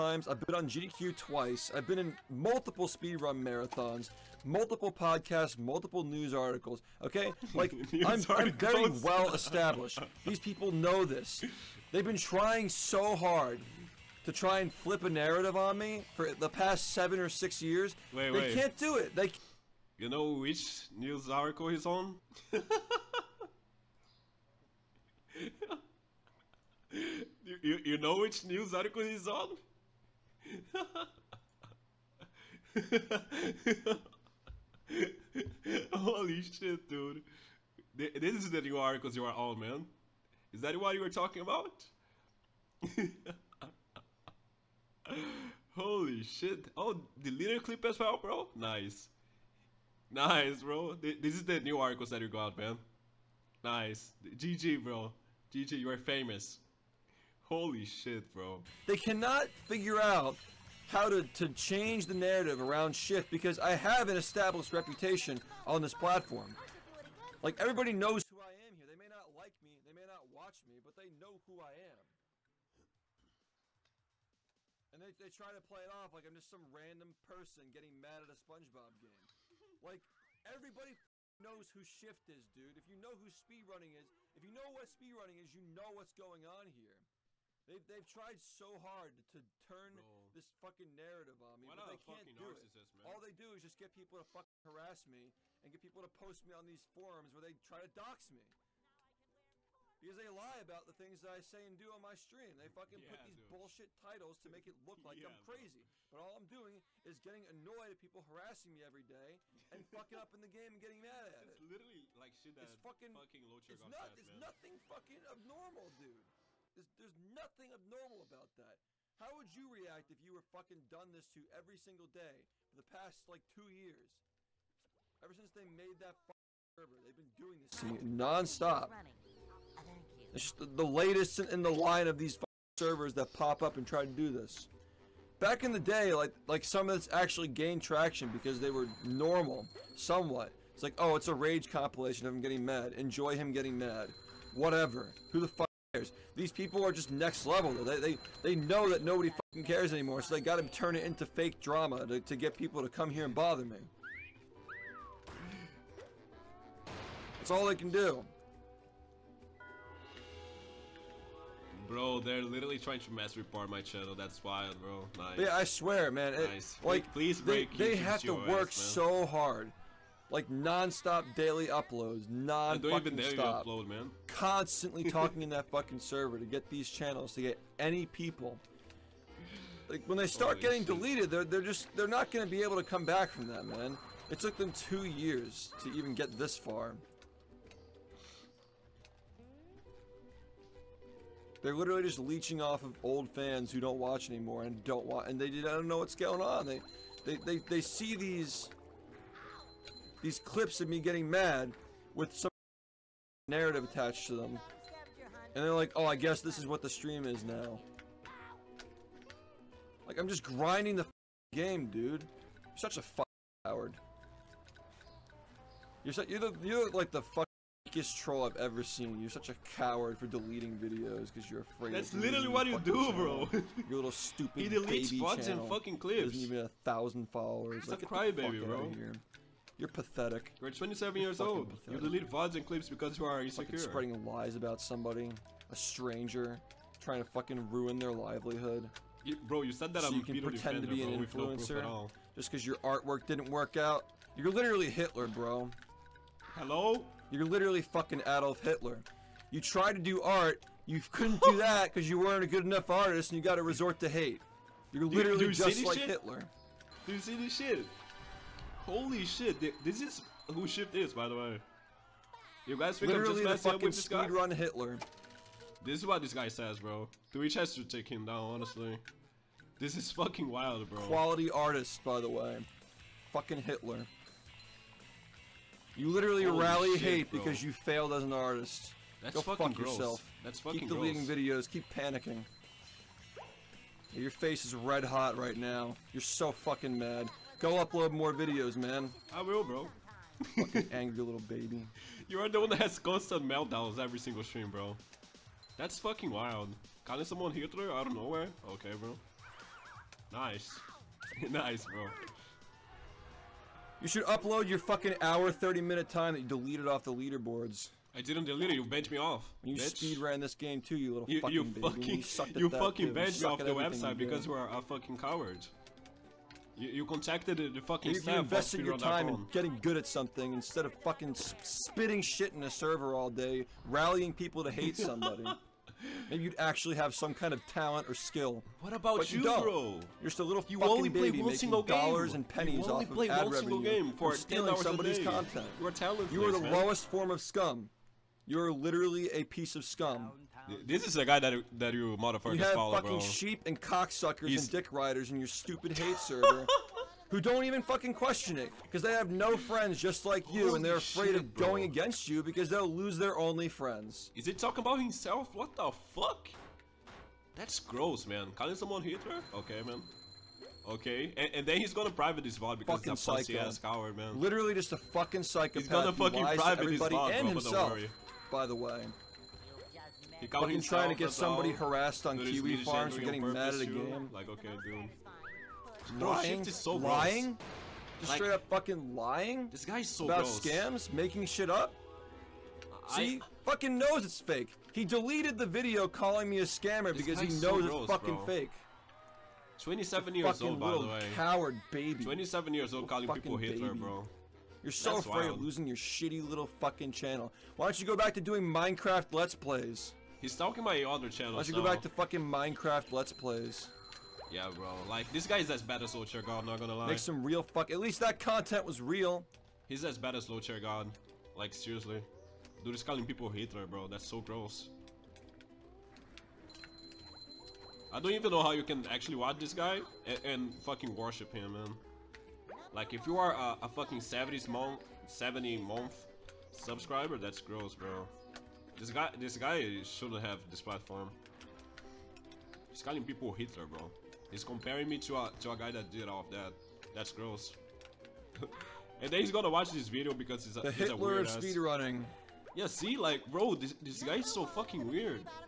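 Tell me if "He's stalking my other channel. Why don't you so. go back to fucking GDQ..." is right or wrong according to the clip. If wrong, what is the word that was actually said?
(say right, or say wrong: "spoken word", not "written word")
wrong: "Minecraft", not "GDQ".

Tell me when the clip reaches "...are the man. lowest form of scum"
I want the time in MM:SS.
05:36.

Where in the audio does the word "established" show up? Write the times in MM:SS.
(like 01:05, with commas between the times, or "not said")
00:09, 01:04.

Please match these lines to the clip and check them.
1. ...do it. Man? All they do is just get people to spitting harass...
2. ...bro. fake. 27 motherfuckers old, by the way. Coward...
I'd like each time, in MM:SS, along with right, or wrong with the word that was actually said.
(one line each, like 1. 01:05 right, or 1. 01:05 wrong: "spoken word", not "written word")
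1. 01:32 wrong: "fucking", not "spitting"
2. 06:28 wrong: "years", not "motherfuckers".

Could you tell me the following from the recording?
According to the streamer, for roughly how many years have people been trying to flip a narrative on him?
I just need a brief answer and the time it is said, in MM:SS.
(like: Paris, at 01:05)
6 or 7 years, at 00:16.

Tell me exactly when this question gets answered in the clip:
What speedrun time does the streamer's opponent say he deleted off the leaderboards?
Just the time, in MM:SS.
05:05.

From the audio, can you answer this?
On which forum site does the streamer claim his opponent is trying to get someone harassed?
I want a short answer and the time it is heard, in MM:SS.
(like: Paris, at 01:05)
Kiwi Farms, at 06:12.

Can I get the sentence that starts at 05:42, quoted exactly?
You have fucking sheep and cocksuckers He's...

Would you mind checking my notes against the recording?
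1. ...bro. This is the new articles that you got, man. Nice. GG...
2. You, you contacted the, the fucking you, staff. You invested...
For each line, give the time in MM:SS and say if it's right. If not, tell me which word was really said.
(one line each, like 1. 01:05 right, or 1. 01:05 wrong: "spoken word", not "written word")
1. 00:50 right
2. 05:16 right.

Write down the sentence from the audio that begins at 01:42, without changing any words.
They fucking yeah, put these dude.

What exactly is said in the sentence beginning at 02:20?
It's like, oh, it's a rage compilation of him getting mad.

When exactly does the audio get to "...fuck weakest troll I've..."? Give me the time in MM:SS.
03:37.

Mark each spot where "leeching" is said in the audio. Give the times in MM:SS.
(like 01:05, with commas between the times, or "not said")
03:12.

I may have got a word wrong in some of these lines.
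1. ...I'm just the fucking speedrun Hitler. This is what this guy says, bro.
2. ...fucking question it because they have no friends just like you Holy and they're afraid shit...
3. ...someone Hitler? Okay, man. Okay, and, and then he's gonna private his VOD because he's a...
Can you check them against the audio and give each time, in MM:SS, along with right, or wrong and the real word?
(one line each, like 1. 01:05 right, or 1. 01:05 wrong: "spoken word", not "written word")
1. 04:23 right
2. 05:47 right
3. 05:58 right.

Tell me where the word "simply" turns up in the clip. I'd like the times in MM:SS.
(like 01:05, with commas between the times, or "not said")
not said.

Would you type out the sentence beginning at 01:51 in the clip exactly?
It's literally like shit that it's fucking, fucking low It's, not, There's nothing fucking abnormal, dude.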